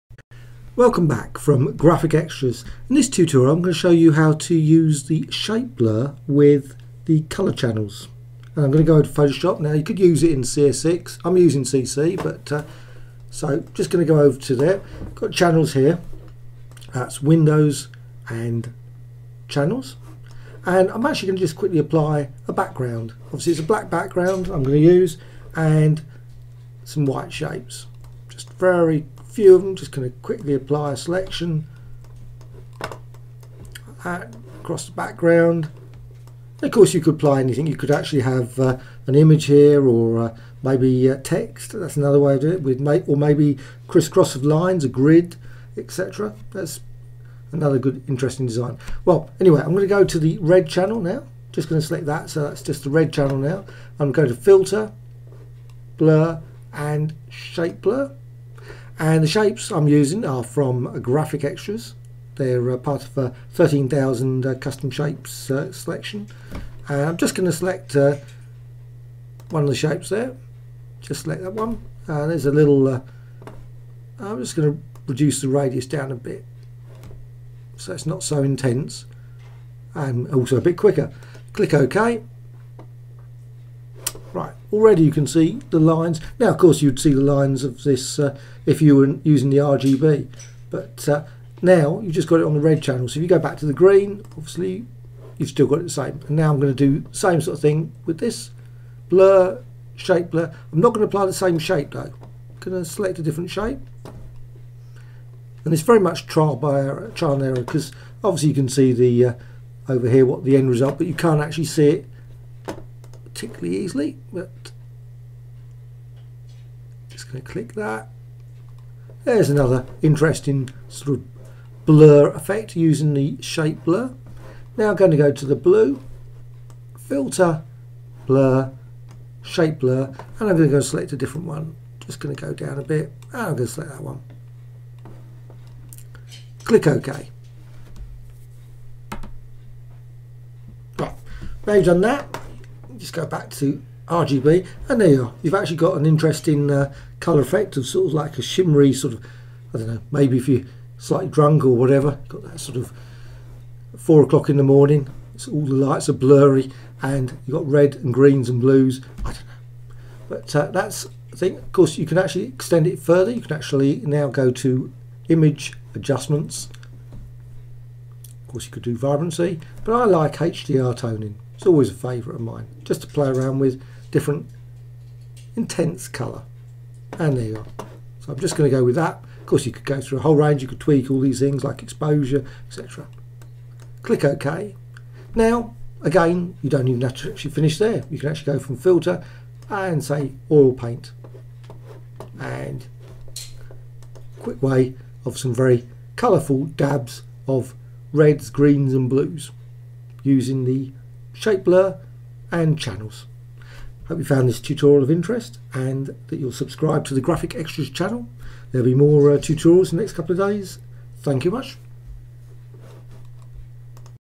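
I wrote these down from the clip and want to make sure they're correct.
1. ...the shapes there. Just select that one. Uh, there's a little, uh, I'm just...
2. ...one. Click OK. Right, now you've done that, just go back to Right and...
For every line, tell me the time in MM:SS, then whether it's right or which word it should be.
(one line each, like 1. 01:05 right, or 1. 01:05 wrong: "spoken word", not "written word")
1. 01:09 right
2. 02:14 wrong: "RGB", not "Right".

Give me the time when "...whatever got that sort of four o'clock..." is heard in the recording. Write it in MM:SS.
02:31.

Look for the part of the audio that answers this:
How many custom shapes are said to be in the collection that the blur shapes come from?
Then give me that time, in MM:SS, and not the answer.
01:03.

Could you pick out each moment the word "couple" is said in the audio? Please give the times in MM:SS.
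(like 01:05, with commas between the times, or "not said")
03:30.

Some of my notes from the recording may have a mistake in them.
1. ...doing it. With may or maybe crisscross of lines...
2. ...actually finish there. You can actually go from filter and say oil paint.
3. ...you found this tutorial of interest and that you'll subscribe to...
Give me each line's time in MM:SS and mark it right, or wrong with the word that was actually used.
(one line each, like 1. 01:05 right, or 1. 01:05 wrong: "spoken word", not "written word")
1. 00:42 right
2. 03:07 right
3. 03:24 right.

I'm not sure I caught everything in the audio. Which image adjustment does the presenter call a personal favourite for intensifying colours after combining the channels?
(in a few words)
HDR toning.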